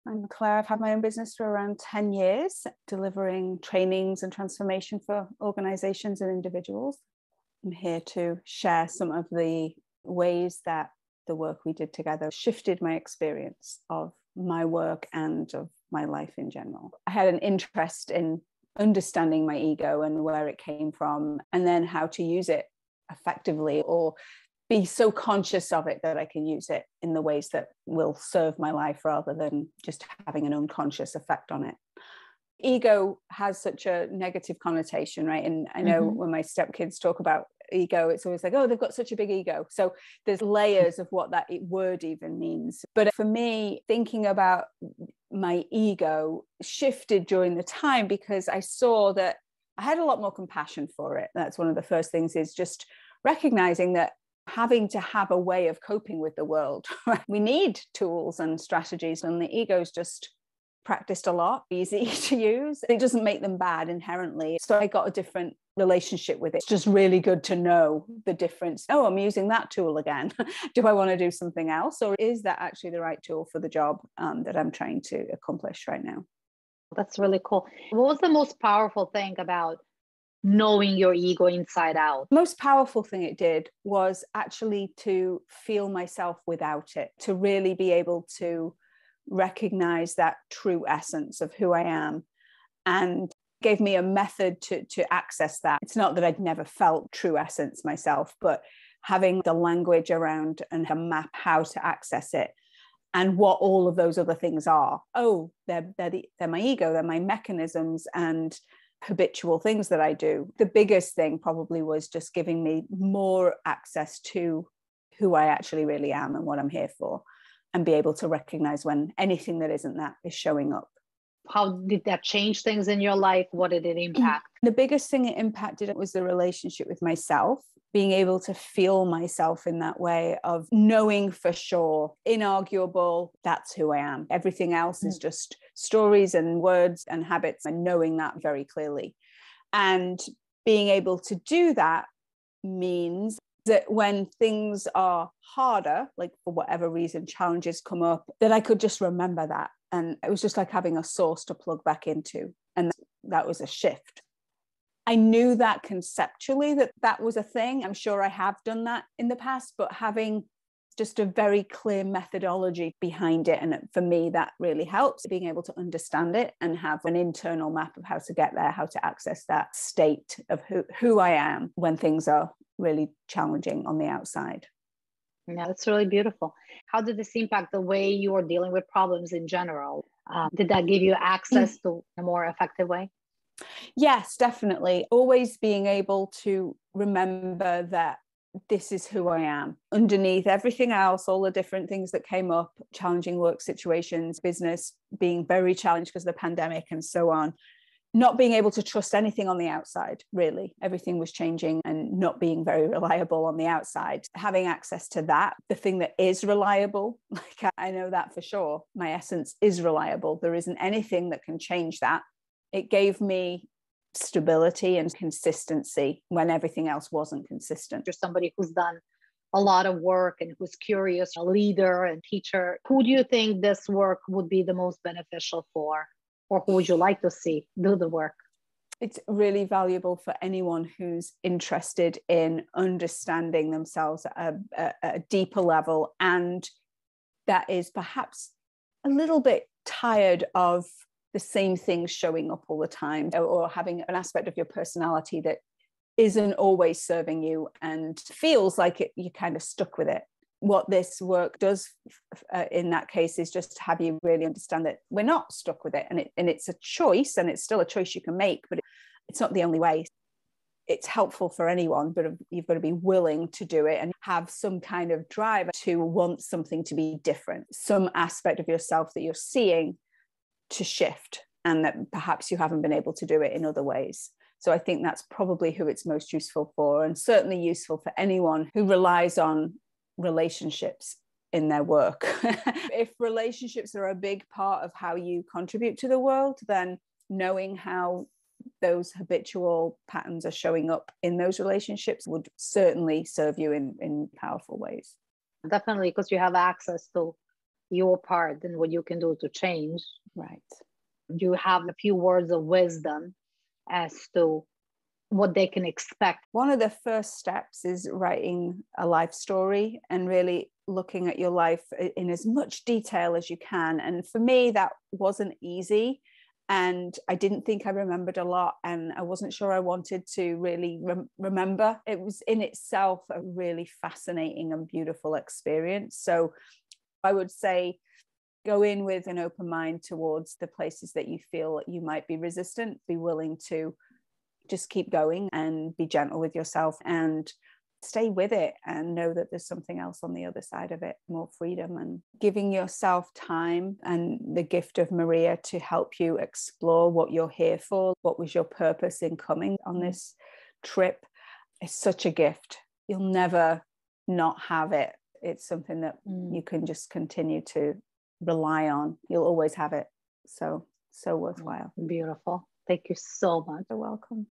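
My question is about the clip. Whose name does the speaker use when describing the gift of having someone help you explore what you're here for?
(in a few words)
Marija.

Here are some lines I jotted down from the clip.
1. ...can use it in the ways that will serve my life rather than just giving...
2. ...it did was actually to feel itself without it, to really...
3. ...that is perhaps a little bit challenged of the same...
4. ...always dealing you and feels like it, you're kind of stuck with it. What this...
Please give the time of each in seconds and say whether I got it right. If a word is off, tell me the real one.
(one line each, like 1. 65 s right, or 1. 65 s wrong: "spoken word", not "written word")
1. 26 s wrong: "having", not "giving"
2. 83 s wrong: "myself", not "itself"
3. 237 s wrong: "tired", not "challenged"
4. 246 s wrong: "serving", not "dealing".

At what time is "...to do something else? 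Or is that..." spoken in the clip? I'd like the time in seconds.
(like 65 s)
71 s.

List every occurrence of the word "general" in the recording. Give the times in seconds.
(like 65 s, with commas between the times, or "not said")
16 s, 179 s.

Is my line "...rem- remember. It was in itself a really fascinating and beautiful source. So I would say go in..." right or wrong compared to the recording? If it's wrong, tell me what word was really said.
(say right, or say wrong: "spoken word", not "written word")
wrong: "experience", not "source".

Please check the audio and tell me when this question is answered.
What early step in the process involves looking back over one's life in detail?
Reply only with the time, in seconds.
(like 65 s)
308 s.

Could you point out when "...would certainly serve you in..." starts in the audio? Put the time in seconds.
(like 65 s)
292 s.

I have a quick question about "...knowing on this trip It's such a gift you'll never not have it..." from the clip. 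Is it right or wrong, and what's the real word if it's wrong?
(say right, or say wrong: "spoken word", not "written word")
wrong: "coming", not "knowing".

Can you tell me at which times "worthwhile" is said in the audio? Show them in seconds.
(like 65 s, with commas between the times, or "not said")
361 s.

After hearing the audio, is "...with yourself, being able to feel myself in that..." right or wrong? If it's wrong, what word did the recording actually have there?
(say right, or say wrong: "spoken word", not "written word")
wrong: "myself", not "yourself".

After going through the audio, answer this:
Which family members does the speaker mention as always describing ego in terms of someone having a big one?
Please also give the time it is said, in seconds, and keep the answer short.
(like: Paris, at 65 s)
Stepkids, at 36 s.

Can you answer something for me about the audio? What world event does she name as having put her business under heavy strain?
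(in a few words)
The pandemic.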